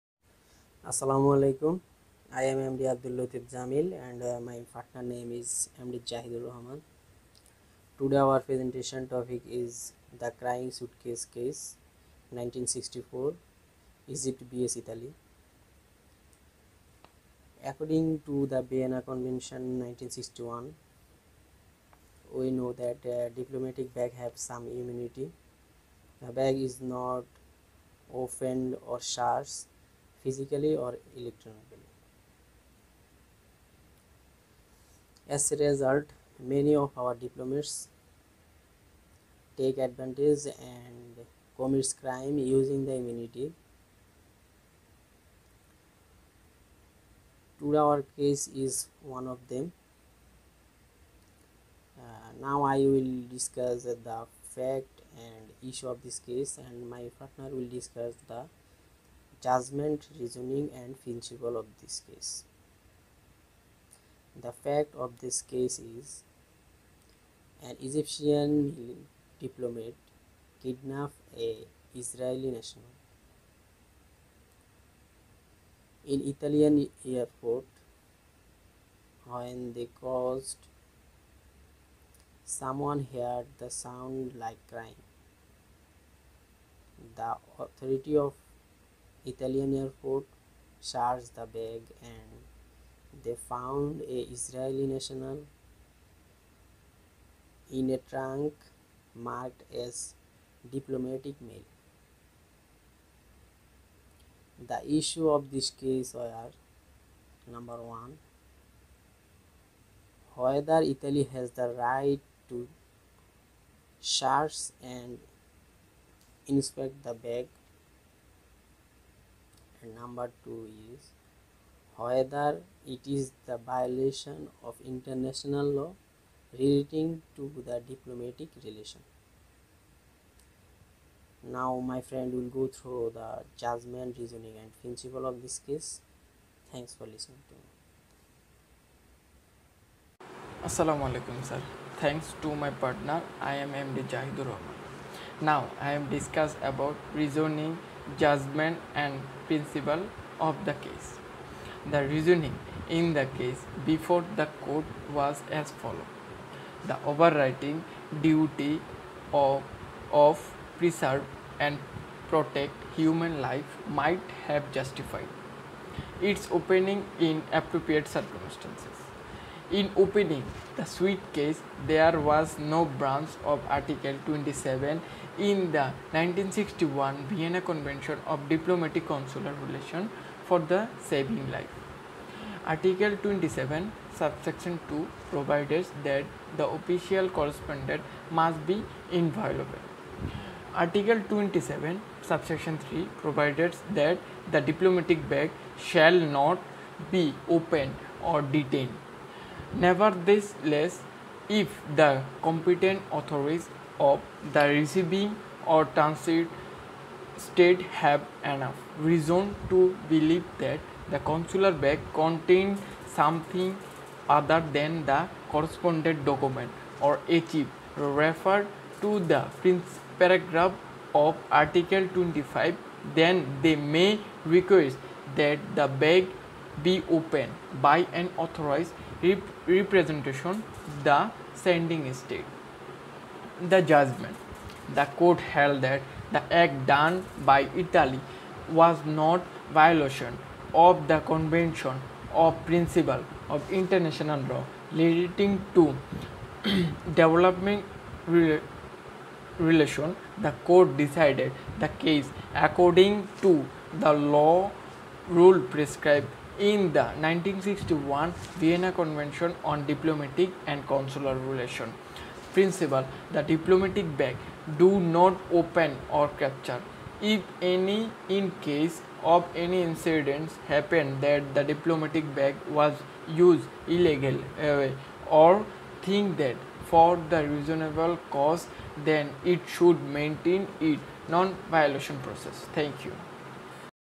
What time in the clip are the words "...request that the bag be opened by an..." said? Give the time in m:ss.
3:44.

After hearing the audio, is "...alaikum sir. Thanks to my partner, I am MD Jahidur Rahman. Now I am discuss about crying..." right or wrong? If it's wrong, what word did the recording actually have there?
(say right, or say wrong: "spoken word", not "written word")
wrong: "reasoning", not "crying".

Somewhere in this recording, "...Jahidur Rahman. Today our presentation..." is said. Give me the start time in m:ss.
0:06.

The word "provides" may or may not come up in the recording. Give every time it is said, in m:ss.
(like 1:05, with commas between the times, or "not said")
3:05, 3:13.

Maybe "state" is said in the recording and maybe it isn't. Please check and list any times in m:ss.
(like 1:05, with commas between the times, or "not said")
3:27, 3:52.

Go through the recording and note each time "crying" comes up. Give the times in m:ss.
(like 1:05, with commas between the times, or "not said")
0:10, 1:24.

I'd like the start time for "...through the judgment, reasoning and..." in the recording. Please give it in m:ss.
2:12.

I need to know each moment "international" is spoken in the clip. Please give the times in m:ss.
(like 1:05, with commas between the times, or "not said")
2:04, 4:03.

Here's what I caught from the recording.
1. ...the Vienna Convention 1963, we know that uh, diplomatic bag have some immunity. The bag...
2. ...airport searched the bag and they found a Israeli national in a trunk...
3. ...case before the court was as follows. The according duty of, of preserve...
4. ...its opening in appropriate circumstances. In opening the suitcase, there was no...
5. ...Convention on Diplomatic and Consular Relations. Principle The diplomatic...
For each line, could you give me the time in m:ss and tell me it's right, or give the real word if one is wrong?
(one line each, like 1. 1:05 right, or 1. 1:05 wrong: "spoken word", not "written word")
1. 0:18 wrong: "1961", not "1963"
2. 1:29 right
3. 2:33 wrong: "overriding", not "according"
4. 2:46 right
5. 4:18 right.